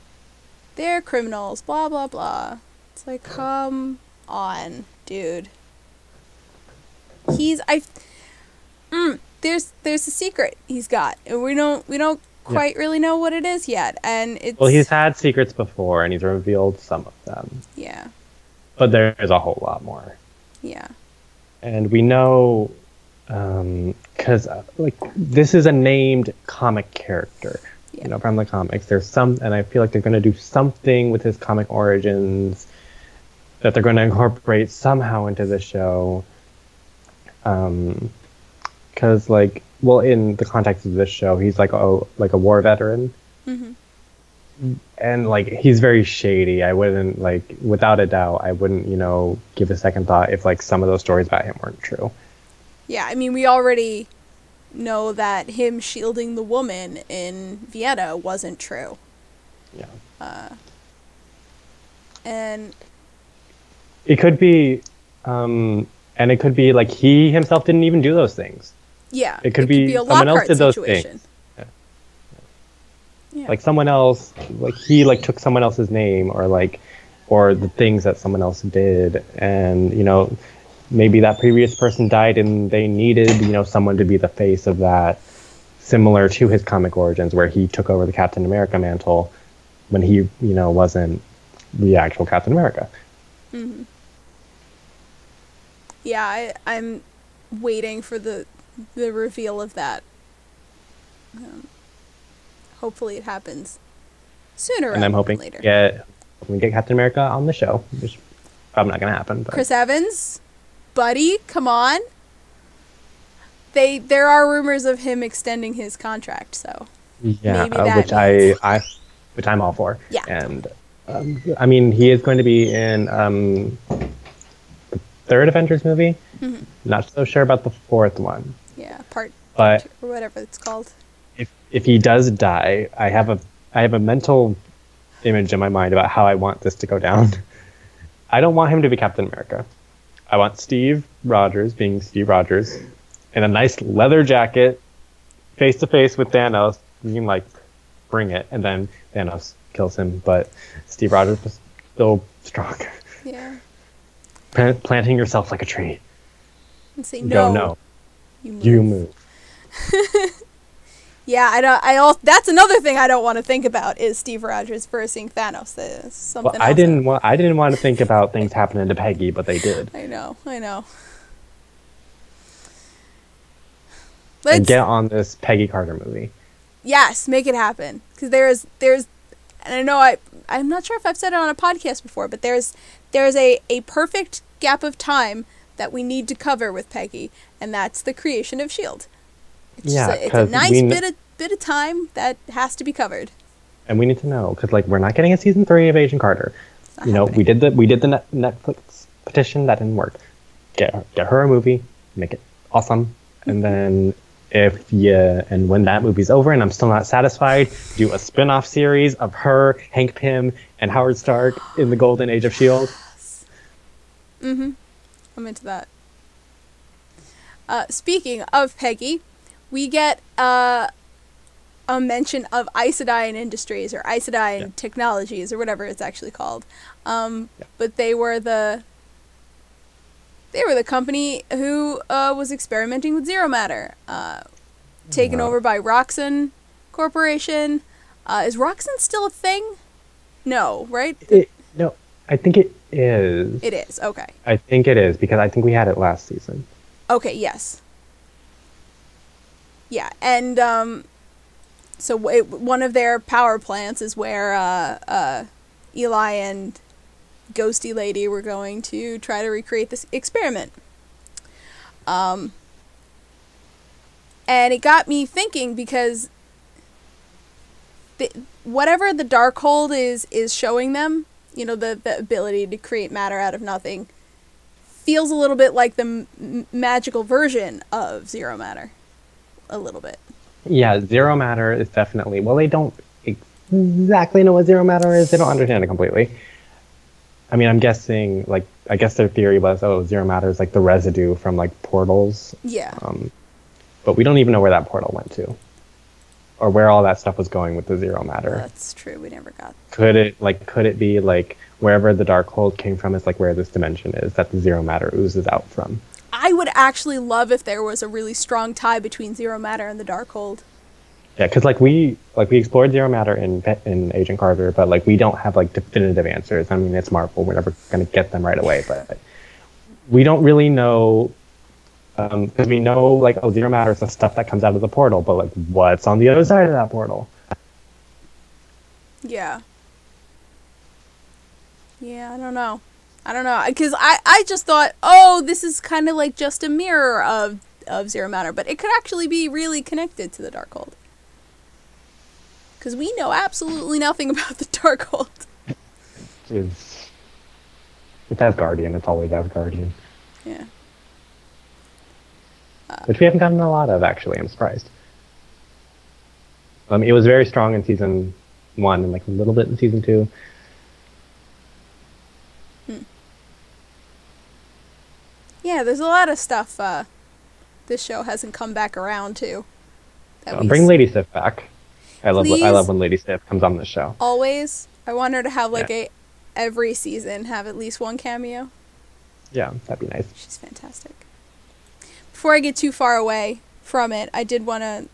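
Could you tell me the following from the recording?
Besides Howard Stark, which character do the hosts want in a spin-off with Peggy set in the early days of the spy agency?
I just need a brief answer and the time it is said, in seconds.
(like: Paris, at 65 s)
Hank Pym, at 209 s.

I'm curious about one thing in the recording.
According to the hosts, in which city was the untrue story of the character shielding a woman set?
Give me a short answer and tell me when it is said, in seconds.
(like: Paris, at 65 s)
Vienna, at 57 s.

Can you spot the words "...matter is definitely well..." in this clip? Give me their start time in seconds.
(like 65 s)
281 s.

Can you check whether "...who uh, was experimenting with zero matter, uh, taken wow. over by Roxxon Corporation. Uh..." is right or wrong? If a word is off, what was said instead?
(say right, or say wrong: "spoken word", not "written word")
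right.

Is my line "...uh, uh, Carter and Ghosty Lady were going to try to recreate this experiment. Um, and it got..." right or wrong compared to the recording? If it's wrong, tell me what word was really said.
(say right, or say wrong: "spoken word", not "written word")
wrong: "Eli", not "Carter".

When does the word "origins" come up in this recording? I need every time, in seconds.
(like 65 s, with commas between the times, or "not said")
31 s, 86 s.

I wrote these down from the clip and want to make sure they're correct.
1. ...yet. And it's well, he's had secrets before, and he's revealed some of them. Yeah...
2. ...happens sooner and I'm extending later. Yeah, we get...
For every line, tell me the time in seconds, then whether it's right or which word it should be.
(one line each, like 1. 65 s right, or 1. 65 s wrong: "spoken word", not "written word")
1. 13 s right
2. 103 s wrong: "hoping", not "extending".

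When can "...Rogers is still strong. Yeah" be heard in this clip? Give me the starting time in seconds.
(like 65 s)
151 s.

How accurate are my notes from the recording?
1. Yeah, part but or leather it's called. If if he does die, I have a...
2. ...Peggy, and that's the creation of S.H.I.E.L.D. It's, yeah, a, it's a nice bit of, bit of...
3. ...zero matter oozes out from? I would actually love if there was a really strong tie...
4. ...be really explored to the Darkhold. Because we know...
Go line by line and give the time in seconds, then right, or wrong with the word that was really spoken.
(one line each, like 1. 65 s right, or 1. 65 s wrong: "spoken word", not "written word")
1. 128 s wrong: "whatever", not "leather"
2. 186 s right
3. 304 s right
4. 339 s wrong: "connected", not "explored".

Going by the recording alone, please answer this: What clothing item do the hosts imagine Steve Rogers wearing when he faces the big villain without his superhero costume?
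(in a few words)
leather jacket.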